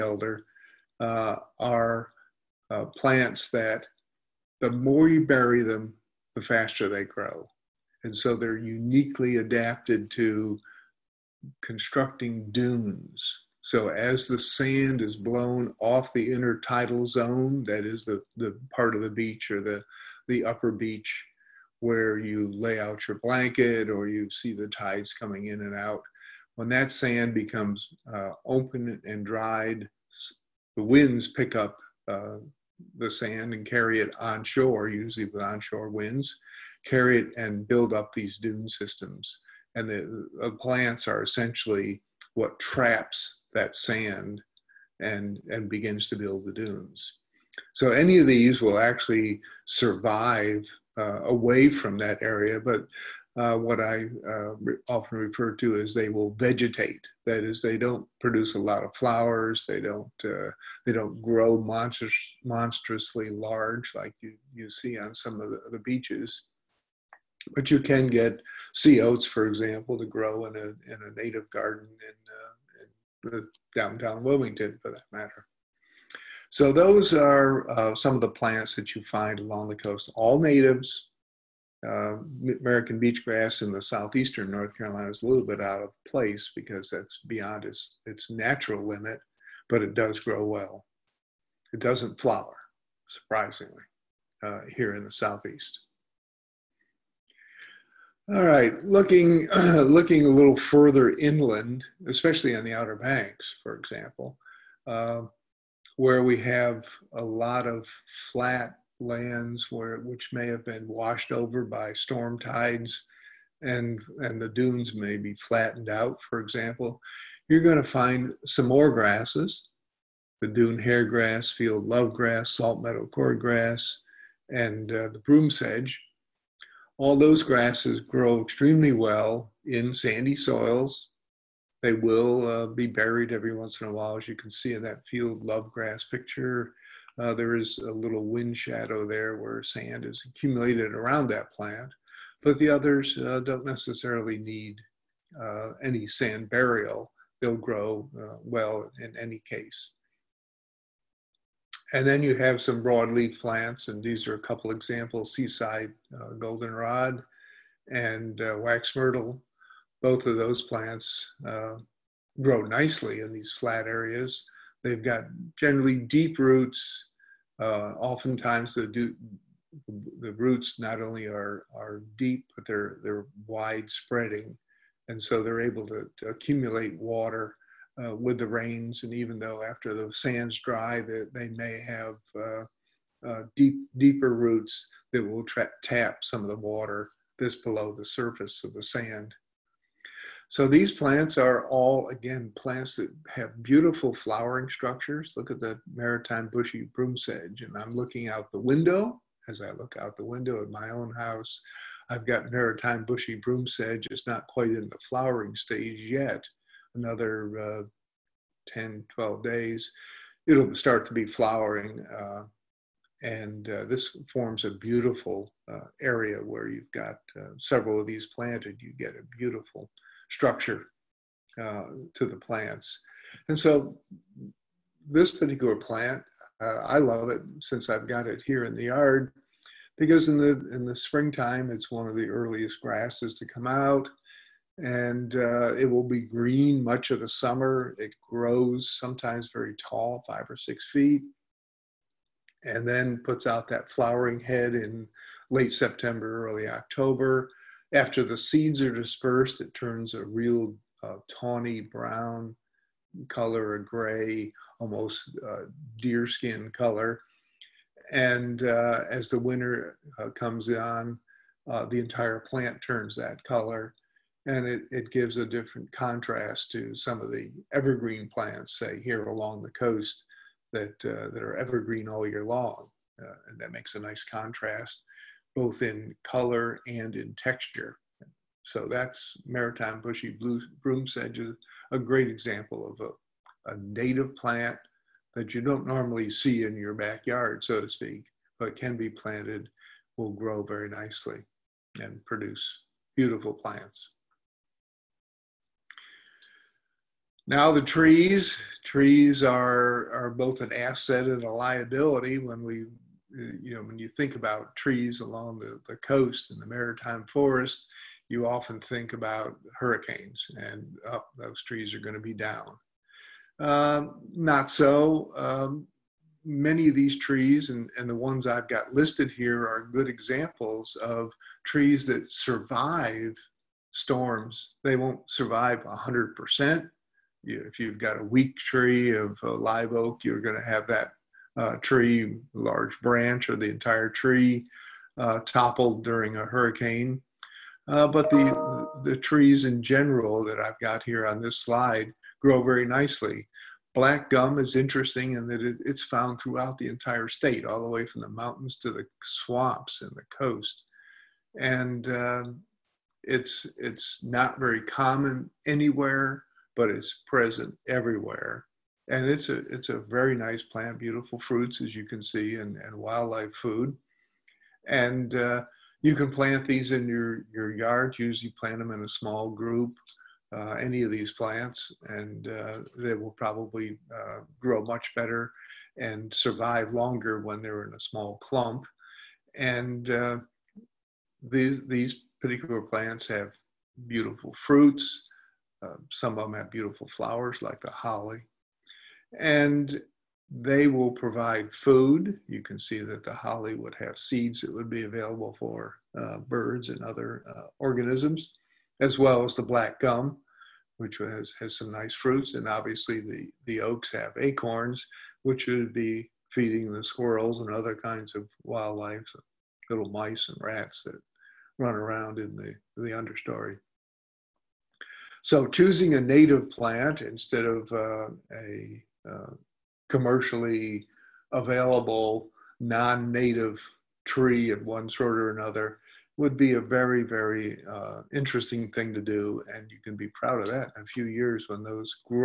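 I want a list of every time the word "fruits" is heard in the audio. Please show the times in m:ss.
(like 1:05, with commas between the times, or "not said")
6:01, 6:24, 6:42.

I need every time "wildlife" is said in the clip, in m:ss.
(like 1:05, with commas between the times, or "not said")
6:02, 6:48.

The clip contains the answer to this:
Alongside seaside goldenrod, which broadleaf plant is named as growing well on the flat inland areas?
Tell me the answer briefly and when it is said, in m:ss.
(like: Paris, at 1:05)
Wax myrtle, at 2:38.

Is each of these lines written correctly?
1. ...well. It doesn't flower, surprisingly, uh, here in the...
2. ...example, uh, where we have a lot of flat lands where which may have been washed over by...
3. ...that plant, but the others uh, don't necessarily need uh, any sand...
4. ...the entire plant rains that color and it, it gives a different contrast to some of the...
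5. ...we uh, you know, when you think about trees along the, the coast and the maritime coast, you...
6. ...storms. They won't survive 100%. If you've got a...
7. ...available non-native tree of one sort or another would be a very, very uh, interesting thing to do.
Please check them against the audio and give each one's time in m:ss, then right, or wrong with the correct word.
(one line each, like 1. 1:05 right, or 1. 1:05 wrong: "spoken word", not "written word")
1. 1:30 right
2. 1:43 right
3. 2:21 right
4. 4:21 wrong: "turns", not "rains"
5. 5:02 wrong: "forest", not "coast"
6. 5:23 right
7. 7:01 right.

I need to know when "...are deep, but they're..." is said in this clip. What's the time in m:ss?
2:51.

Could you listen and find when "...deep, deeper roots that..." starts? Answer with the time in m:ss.
3:03.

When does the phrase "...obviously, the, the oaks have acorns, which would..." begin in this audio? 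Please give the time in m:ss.
6:42.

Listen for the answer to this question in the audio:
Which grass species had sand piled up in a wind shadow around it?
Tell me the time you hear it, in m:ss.
2:15.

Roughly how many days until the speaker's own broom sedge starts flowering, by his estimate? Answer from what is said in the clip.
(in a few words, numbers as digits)
10 to 12 days.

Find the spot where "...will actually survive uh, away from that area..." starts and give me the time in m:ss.
0:48.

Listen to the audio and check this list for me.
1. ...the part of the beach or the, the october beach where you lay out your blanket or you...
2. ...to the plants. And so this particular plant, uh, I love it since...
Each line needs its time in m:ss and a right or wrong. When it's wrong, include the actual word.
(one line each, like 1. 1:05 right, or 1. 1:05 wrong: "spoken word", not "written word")
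1. 0:18 wrong: "upper", not "october"
2. 3:42 right.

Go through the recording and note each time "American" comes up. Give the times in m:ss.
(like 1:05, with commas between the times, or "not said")
1:22.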